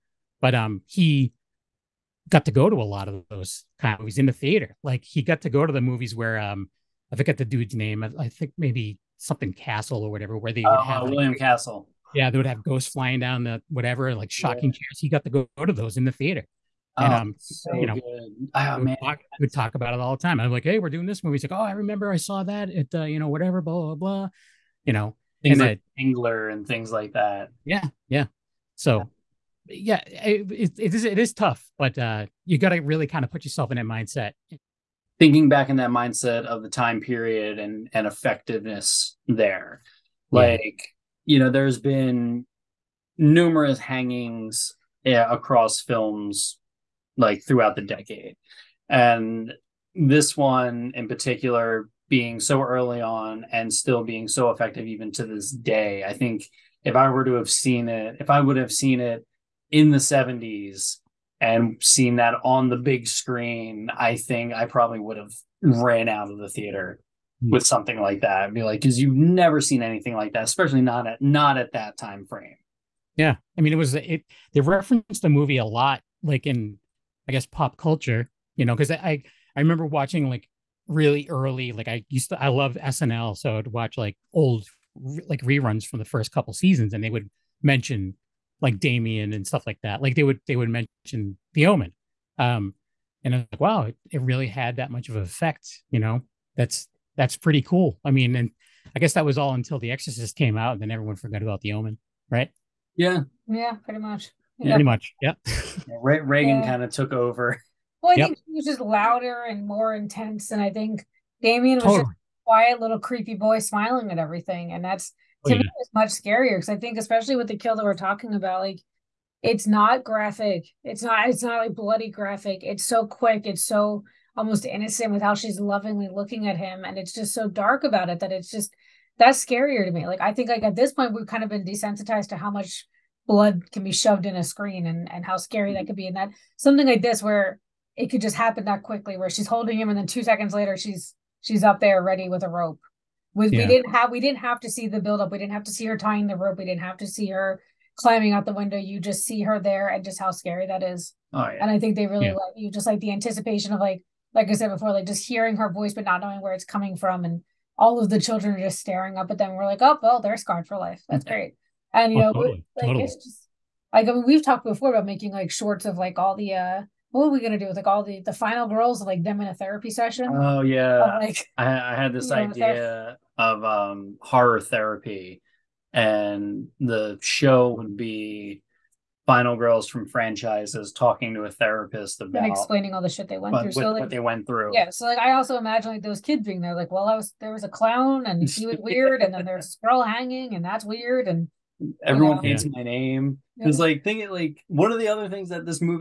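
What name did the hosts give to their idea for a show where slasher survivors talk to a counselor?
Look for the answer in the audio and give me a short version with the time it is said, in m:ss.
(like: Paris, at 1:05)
horror therapy, at 2:54.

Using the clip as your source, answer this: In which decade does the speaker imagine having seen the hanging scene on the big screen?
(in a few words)
the 70s.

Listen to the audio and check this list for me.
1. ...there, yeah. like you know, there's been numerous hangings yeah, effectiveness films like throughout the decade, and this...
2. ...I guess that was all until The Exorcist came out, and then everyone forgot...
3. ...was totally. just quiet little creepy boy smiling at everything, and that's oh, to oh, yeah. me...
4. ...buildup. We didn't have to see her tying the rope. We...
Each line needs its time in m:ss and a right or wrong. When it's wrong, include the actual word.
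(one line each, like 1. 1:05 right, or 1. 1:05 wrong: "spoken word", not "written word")
1. 0:39 wrong: "across", not "effectiveness"
2. 1:38 right
3. 1:51 right
4. 2:24 right.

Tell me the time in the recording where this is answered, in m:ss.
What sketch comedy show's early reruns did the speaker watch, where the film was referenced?
1:22.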